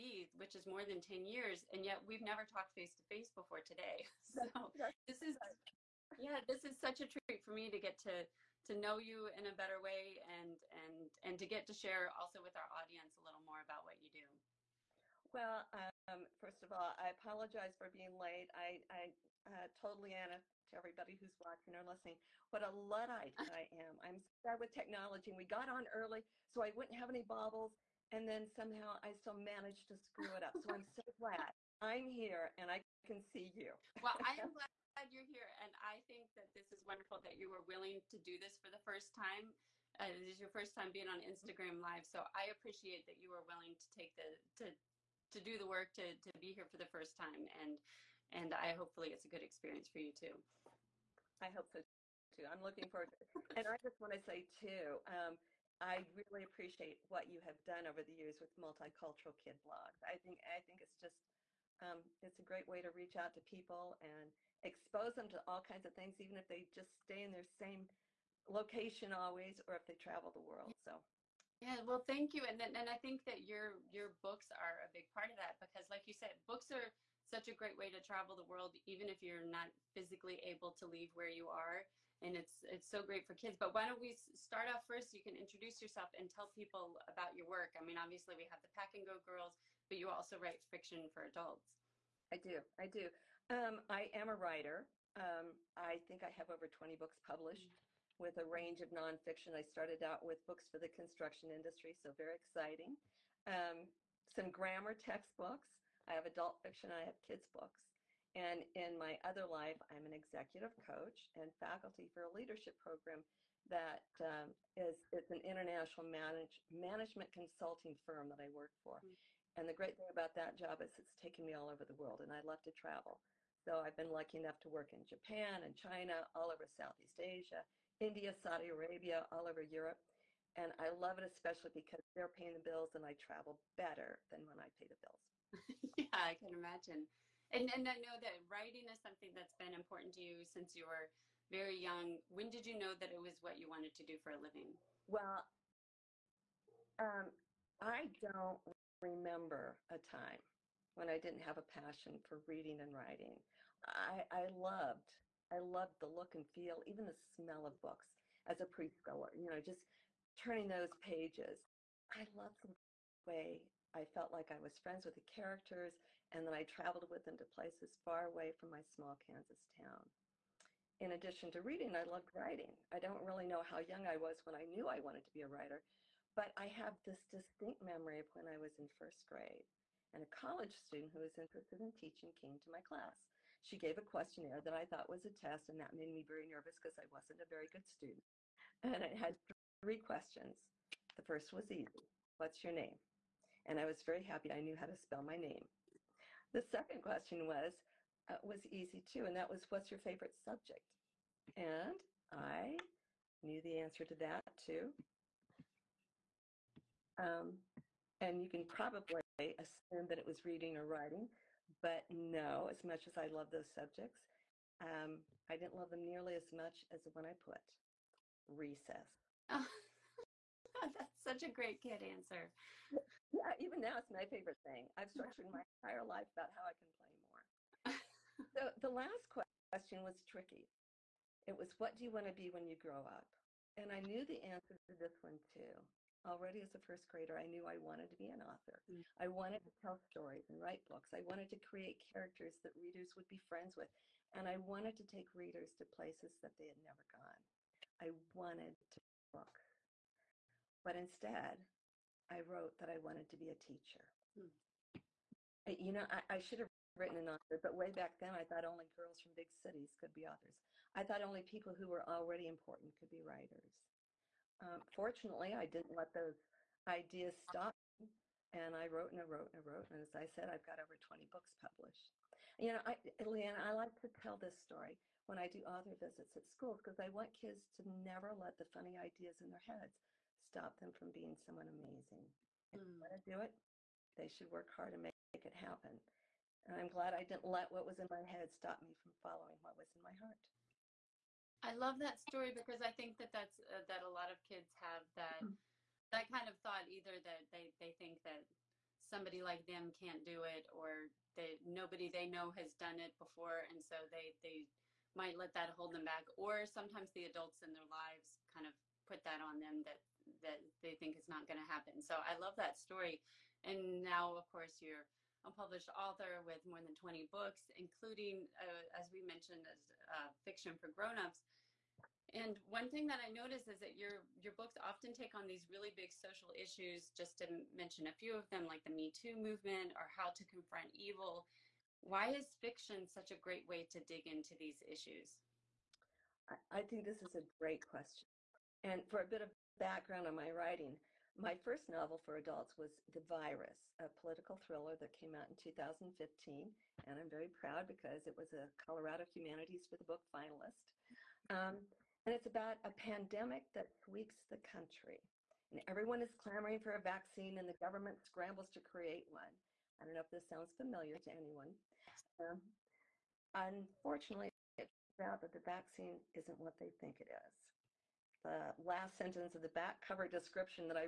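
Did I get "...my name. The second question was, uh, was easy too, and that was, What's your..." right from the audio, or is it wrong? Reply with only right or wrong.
right.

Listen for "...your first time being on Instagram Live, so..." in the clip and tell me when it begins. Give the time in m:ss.
0:40.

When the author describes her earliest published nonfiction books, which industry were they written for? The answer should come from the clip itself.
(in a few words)
construction industry.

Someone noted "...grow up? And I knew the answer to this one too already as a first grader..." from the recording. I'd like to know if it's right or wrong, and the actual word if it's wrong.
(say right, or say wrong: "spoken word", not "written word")
right.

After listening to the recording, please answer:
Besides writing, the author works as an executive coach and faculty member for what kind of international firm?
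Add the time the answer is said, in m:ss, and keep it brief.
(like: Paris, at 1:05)
management consulting firm, at 1:56.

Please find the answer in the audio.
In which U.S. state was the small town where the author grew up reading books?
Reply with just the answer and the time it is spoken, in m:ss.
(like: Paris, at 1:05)
Kansas, at 2:49.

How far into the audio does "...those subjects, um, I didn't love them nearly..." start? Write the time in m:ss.
3:33.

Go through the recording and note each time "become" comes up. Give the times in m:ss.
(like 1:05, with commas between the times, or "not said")
not said.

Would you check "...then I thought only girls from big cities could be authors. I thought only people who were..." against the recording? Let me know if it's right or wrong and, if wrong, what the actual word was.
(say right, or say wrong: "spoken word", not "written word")
right.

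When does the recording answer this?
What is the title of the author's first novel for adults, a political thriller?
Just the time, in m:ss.
5:43.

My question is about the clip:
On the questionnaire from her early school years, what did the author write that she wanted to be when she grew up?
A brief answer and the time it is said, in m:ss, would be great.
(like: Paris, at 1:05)
a teacher, at 4:13.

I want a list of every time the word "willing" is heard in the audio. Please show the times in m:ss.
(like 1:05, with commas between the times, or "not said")
0:37, 0:43.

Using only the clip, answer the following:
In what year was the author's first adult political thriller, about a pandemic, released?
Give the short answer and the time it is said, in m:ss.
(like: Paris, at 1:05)
2015, at 5:45.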